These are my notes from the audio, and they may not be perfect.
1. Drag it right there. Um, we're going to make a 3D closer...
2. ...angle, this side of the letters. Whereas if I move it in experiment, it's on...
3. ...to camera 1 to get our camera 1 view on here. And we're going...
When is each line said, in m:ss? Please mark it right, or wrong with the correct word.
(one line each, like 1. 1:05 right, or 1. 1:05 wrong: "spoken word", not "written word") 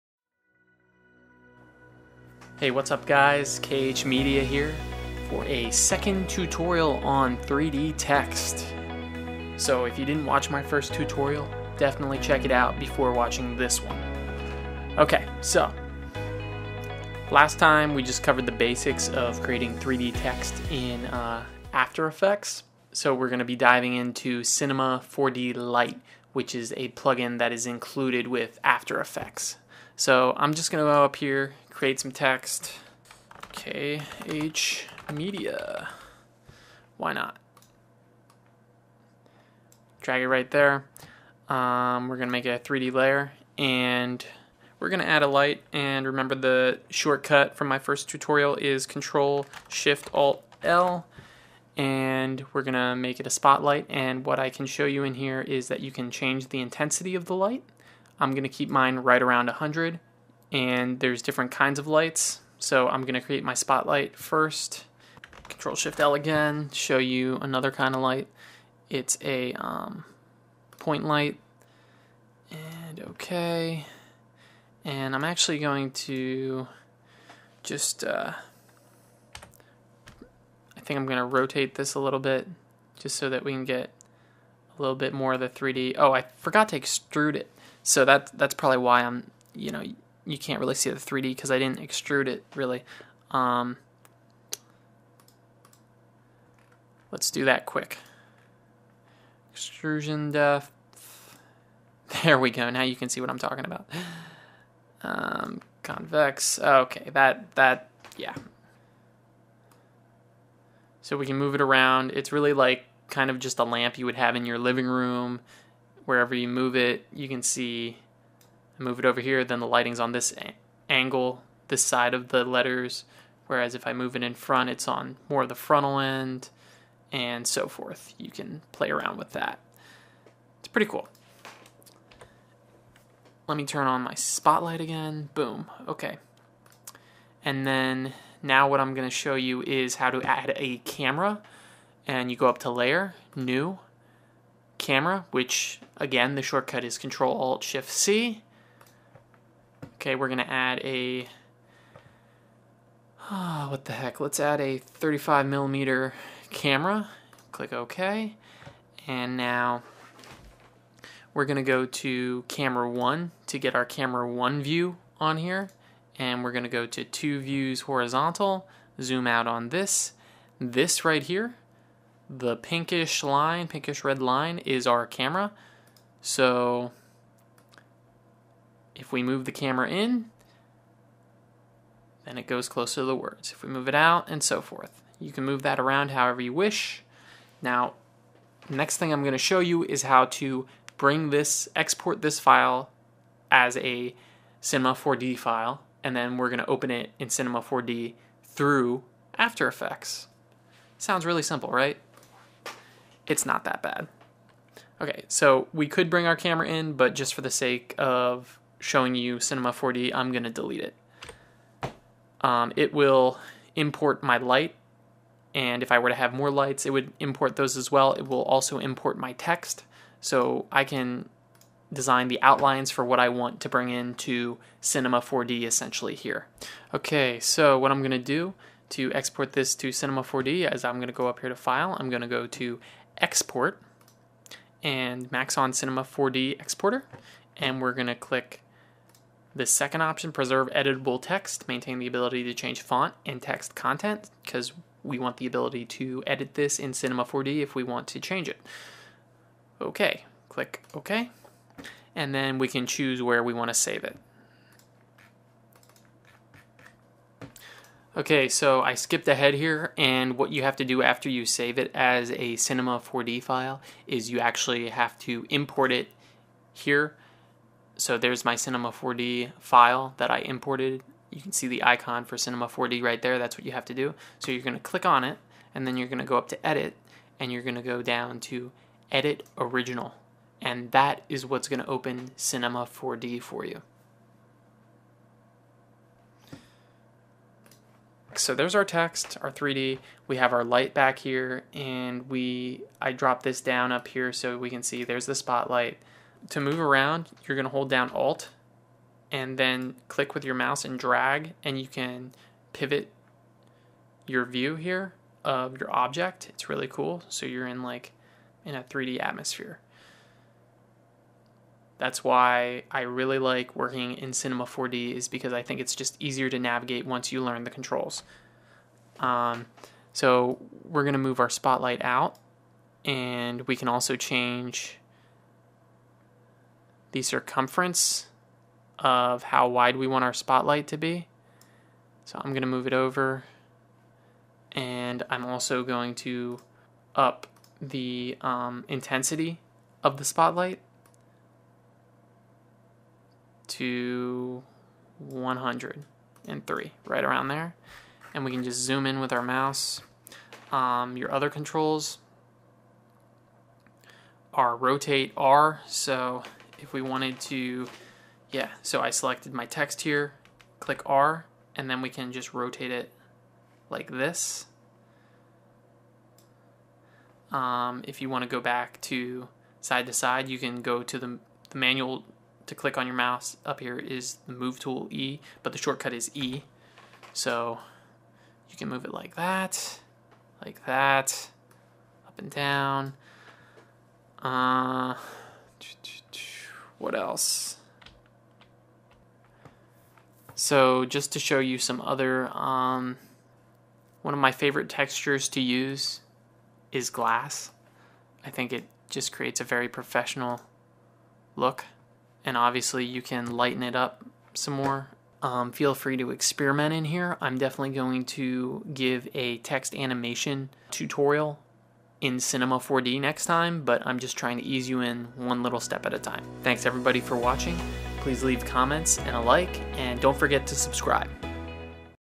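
1. 0:40 wrong: "layer", not "closer"
2. 2:00 wrong: "front", not "experiment"
3. 2:41 right.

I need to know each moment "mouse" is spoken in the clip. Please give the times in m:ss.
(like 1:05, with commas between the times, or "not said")
5:00, 5:49, 6:13.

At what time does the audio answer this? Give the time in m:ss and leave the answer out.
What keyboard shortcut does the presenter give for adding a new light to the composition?
0:48.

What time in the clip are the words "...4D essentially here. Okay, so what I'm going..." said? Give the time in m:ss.
3:45.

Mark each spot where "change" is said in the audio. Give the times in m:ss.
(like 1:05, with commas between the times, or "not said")
0:56, 4:02, 4:08, 5:24.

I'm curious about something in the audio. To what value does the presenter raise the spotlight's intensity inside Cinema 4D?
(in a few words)
103.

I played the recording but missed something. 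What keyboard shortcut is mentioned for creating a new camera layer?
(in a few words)
Control Alt Shift C.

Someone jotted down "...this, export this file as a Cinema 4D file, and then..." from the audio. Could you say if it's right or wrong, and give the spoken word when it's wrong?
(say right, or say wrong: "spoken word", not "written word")
right.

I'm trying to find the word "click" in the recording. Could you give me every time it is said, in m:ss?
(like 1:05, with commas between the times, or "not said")
2:37, 3:58, 4:10, 4:34, 5:00, 6:00, 6:12.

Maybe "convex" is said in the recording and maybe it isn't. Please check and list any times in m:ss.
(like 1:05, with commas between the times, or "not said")
1:45.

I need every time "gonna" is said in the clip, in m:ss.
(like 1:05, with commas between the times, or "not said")
1:03, 1:21.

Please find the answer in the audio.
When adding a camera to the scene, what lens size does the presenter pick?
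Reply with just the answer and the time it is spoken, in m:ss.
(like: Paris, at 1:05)
35 millimeter, at 2:34.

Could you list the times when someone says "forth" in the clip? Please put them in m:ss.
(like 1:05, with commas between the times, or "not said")
2:07, 3:04.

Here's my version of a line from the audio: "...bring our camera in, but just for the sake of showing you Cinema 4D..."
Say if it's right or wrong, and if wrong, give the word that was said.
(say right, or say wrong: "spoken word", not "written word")
right.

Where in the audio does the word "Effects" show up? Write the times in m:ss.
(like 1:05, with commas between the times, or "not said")
0:22, 0:29, 3:19.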